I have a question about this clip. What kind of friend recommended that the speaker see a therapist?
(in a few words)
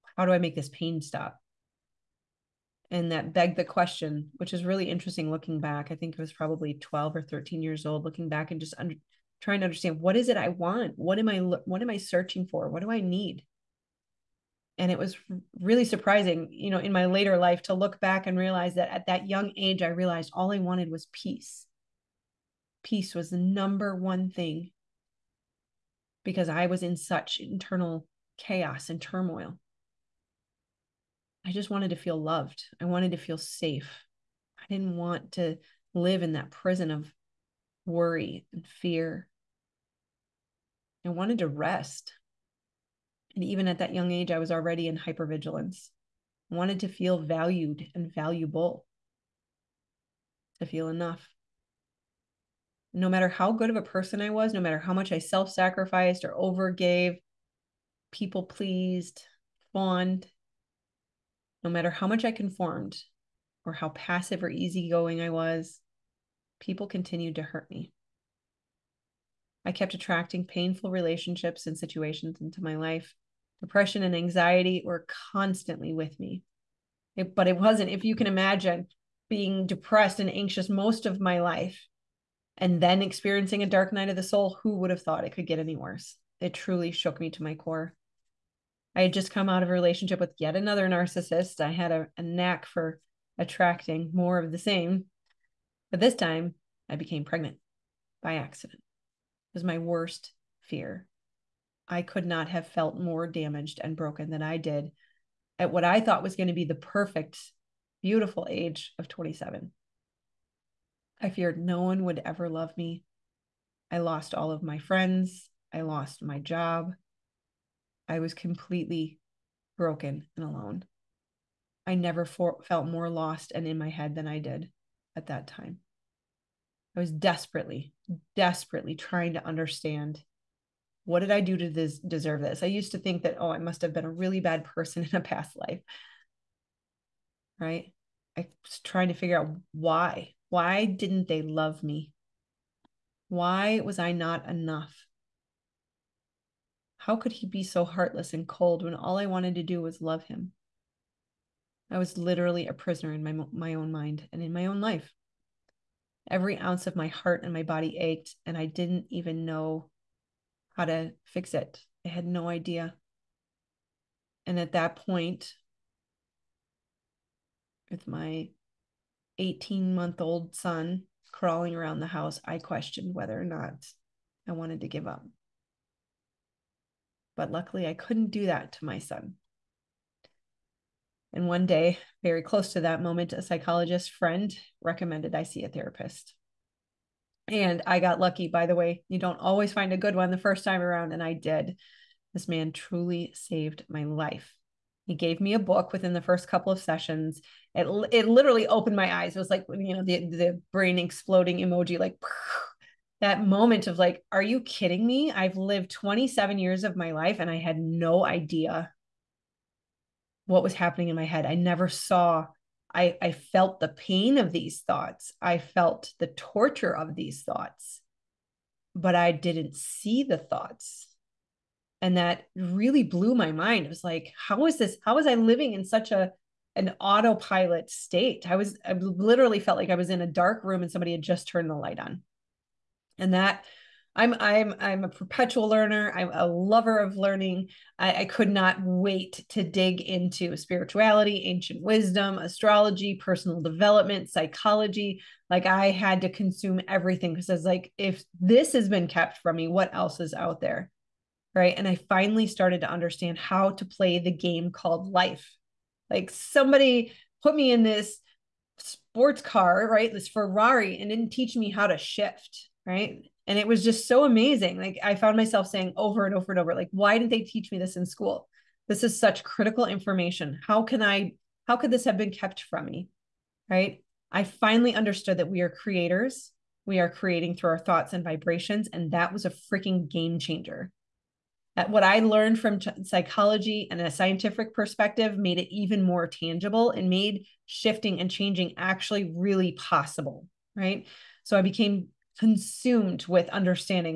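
psychologist friend.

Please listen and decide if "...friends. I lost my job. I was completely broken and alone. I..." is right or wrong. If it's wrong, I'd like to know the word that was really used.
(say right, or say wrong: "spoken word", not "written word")
right.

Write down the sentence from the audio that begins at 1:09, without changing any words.
I kept attracting painful relationships and situations into my life.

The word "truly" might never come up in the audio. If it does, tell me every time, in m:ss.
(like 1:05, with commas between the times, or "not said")
1:26, 3:12.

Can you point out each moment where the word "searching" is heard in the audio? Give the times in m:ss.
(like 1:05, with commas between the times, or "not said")
0:11.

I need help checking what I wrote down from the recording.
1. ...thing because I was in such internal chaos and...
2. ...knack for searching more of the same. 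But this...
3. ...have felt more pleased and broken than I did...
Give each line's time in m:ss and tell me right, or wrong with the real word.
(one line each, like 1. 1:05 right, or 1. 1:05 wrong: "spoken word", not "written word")
1. 0:24 right
2. 1:32 wrong: "attracting", not "searching"
3. 1:42 wrong: "damaged", not "pleased".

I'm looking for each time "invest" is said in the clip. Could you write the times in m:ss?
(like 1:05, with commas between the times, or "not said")
not said.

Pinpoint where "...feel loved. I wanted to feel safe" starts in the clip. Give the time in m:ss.
0:31.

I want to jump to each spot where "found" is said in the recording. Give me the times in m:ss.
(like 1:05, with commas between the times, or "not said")
4:25.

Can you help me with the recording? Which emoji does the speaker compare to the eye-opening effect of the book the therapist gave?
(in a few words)
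brain exploding emoji.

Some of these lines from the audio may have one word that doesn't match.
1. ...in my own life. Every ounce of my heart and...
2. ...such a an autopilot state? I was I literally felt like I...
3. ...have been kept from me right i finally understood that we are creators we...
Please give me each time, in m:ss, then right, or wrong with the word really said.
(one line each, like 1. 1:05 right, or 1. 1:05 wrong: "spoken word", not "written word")
1. 2:34 right
2. 3:45 right
3. 4:32 right.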